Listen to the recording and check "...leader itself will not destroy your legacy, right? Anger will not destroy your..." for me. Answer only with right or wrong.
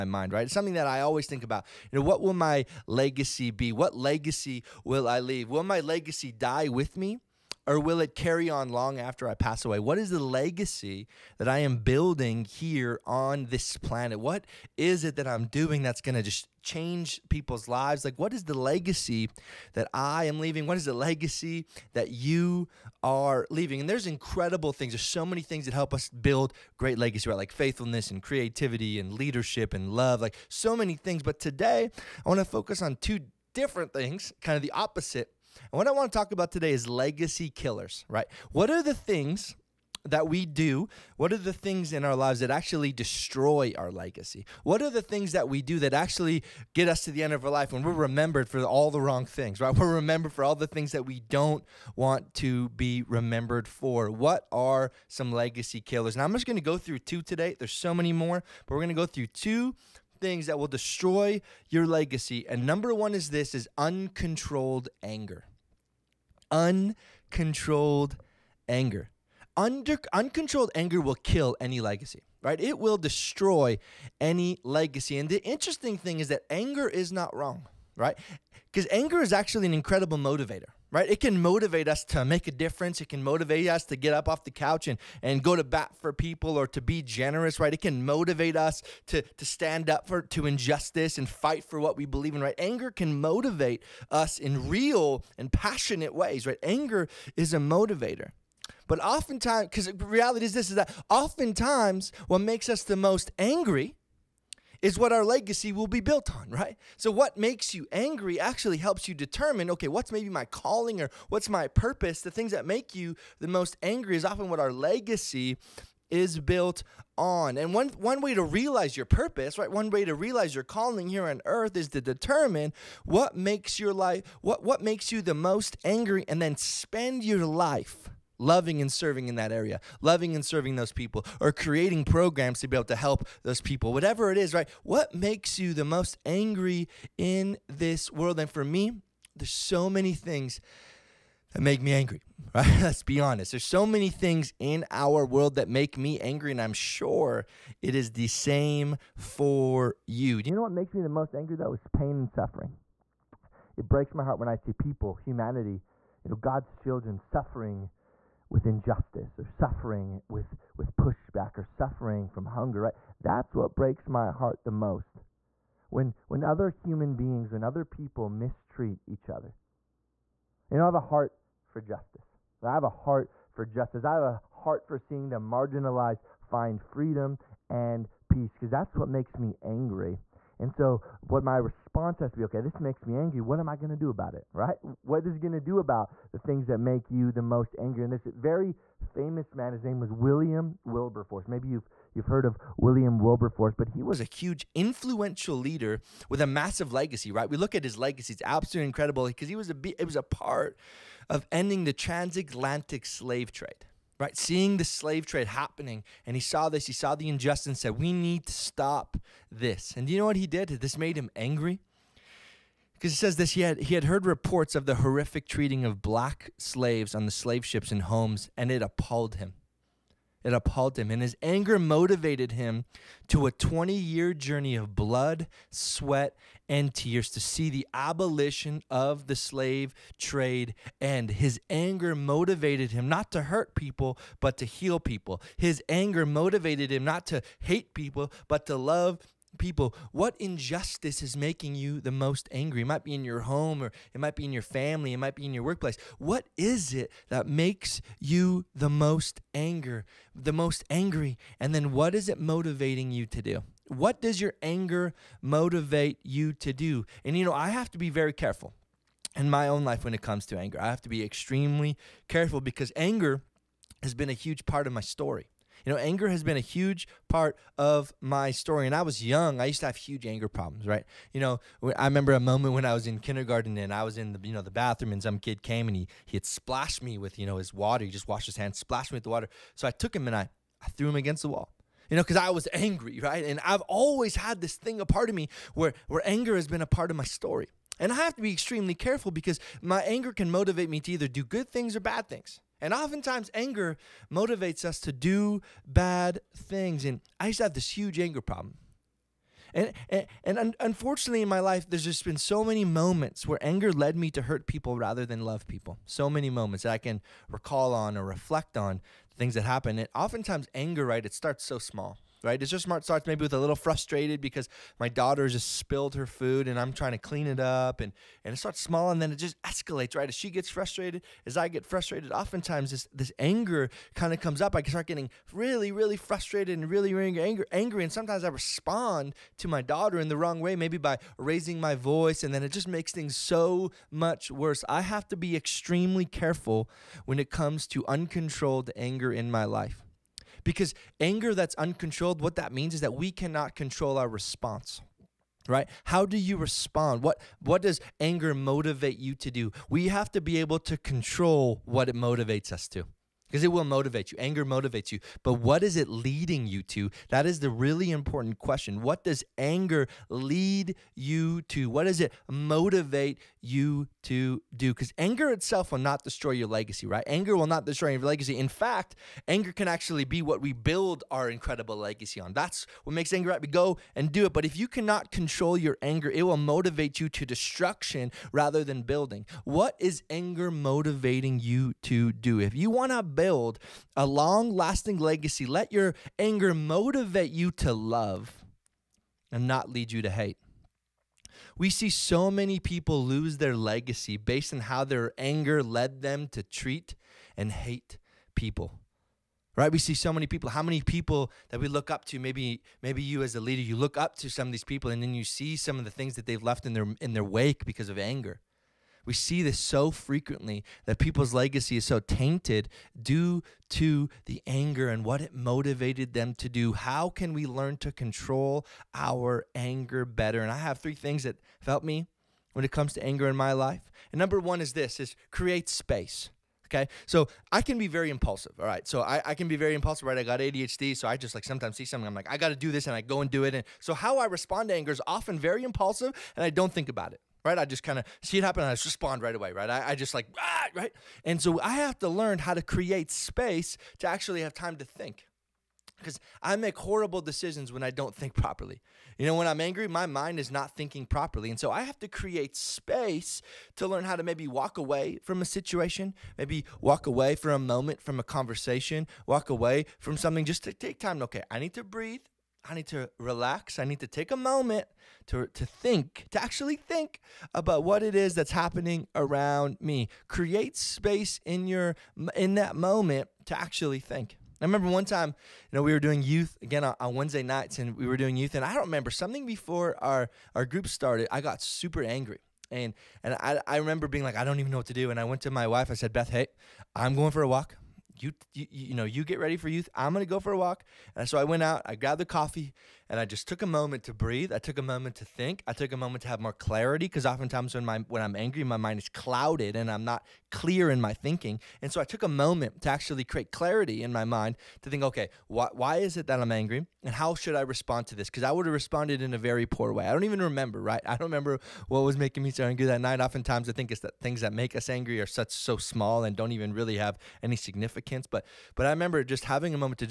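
wrong.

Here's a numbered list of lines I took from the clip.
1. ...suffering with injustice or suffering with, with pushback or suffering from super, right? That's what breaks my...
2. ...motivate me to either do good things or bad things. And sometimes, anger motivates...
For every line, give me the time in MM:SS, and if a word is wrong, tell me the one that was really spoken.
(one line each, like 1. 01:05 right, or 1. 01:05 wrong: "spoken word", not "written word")
1. 02:37 wrong: "hunger", not "super"
2. 04:50 wrong: "oftentimes", not "sometimes".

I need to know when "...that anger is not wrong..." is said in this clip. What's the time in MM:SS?
01:16.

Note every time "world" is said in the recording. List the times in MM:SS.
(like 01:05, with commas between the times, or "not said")
02:18, 02:25.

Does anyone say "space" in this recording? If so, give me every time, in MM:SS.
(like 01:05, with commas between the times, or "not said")
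07:05, 07:23, 07:32, 07:50.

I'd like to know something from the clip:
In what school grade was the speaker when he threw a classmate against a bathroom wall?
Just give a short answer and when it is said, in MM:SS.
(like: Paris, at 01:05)
Kindergarten, at 04:33.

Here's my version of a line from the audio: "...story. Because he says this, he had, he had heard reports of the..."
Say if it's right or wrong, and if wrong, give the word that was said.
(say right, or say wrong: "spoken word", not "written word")
wrong: "angry", not "story".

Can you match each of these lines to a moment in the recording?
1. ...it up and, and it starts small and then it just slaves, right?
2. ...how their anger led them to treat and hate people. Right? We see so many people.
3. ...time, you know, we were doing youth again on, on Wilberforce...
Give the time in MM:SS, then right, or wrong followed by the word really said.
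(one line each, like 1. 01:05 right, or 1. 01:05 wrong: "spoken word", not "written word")
1. 05:17 wrong: "escalates", not "slaves"
2. 06:34 right
3. 07:55 wrong: "Wednesday", not "Wilberforce".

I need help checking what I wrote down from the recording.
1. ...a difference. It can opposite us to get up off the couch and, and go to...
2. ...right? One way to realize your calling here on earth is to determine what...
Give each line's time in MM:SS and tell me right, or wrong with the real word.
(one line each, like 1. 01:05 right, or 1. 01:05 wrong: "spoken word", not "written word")
1. 01:22 wrong: "motivate", not "opposite"
2. 01:59 right.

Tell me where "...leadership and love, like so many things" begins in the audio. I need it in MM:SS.
00:29.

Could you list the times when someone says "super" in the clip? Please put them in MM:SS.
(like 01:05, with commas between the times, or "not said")
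08:01.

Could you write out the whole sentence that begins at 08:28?
Because I would have responded in a very poor way.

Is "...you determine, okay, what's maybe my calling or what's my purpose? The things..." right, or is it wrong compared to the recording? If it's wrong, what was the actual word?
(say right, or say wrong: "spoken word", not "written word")
right.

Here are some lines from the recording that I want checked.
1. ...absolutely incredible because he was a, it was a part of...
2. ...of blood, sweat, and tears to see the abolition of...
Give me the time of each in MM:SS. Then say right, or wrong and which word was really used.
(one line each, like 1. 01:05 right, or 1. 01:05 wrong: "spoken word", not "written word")
1. 03:18 right
2. 03:44 right.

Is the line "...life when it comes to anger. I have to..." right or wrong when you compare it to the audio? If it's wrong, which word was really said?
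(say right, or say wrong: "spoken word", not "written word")
right.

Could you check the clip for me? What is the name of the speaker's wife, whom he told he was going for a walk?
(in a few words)
Beth.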